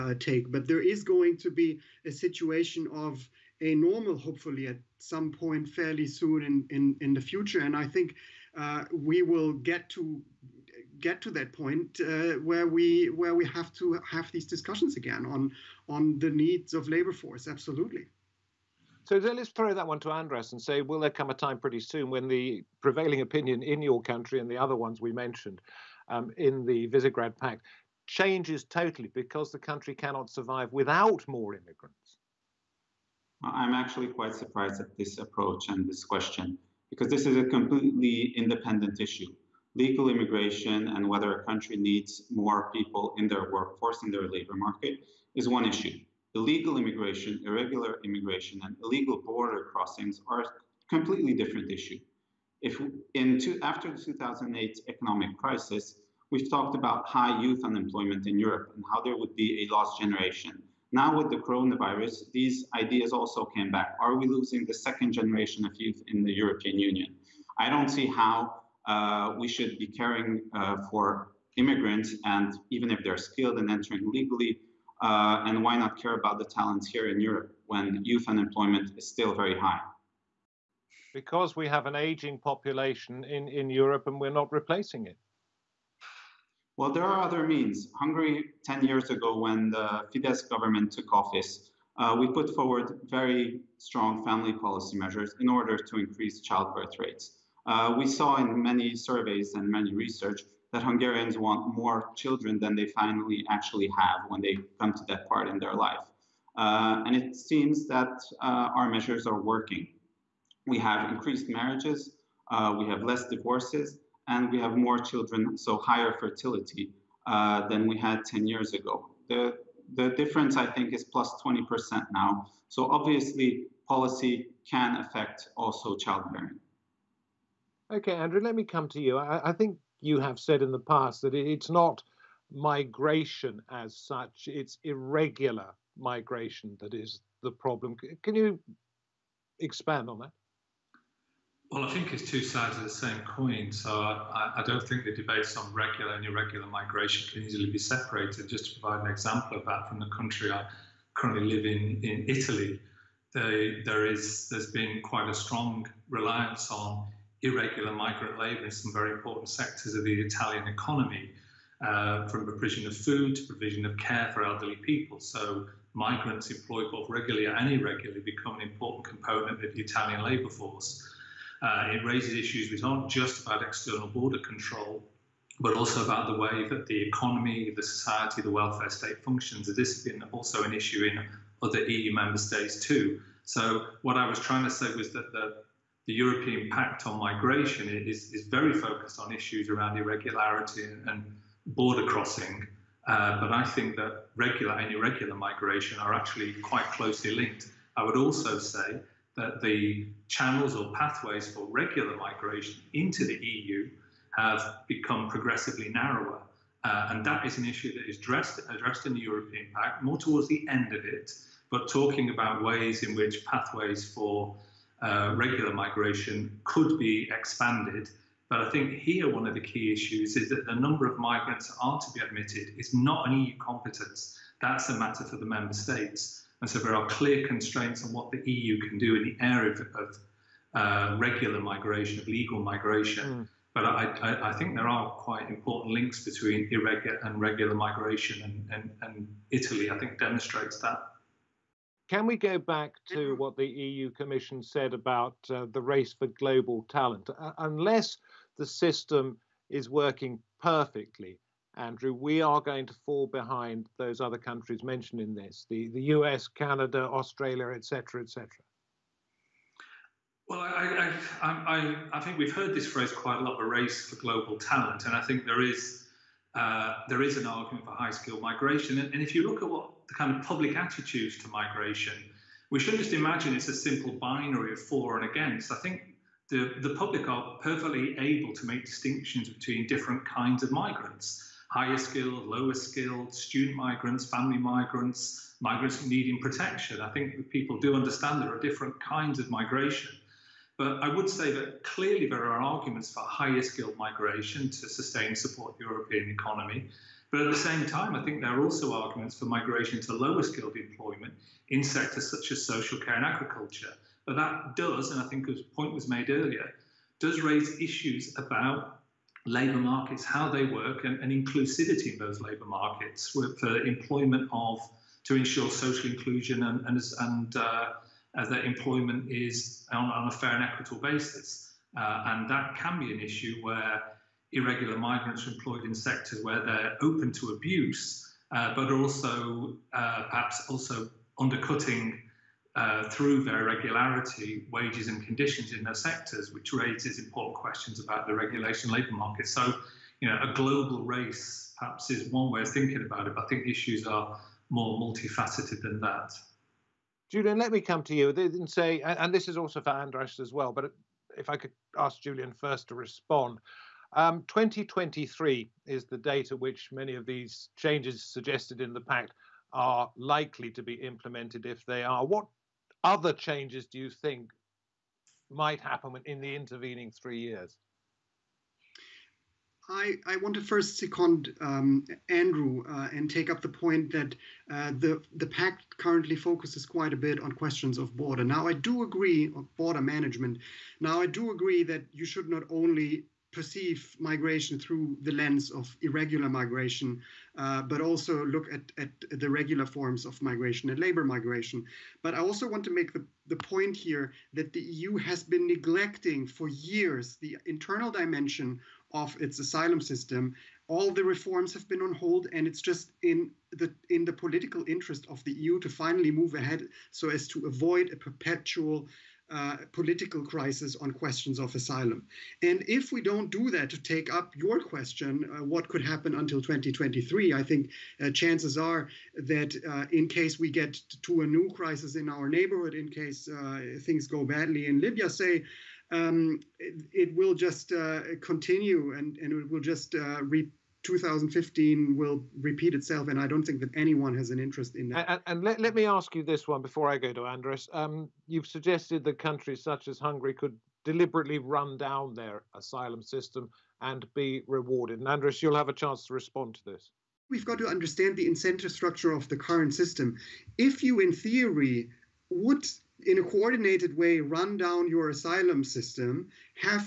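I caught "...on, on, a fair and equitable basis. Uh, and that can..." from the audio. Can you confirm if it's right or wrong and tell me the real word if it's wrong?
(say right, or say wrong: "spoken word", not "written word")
right.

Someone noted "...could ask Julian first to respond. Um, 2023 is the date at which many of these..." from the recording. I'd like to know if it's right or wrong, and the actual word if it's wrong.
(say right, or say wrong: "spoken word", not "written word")
right.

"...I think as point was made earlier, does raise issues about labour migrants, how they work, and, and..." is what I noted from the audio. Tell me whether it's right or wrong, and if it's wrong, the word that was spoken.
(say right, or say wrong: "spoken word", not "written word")
wrong: "markets", not "migrants".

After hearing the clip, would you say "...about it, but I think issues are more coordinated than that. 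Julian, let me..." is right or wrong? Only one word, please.
wrong.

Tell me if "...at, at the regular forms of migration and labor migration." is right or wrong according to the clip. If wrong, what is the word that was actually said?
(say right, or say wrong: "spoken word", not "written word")
right.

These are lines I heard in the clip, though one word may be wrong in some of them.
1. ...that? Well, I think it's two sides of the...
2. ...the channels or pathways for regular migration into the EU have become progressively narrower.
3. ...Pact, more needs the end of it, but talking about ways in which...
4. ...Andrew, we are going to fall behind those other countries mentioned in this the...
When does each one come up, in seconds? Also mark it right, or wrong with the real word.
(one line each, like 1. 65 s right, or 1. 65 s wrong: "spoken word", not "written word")
1. 140 s right
2. 199 s right
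3. 209 s wrong: "towards", not "needs"
4. 251 s right.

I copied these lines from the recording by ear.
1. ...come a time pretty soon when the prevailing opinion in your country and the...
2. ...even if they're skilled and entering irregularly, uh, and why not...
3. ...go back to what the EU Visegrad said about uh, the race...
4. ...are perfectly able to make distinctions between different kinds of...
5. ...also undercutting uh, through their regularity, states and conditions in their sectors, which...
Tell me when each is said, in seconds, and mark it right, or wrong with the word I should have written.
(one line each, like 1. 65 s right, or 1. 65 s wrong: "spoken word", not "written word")
1. 21 s right
2. 72 s wrong: "legally", not "irregularly"
3. 242 s wrong: "Commission", not "Visegrad"
4. 277 s right
5. 330 s wrong: "wages", not "states".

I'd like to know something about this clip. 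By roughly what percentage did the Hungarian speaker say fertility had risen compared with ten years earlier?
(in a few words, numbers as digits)
20%.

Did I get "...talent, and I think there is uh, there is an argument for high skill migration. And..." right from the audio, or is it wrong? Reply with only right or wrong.
right.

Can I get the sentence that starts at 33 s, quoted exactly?
I'm actually quite surprised at this approach and this question because this is a completely independent issue.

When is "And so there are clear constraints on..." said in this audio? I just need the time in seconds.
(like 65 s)
226 s.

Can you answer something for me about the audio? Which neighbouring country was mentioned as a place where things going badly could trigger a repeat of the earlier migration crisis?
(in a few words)
Libya.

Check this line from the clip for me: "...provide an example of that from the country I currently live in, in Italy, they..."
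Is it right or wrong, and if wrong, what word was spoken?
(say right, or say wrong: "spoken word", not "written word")
right.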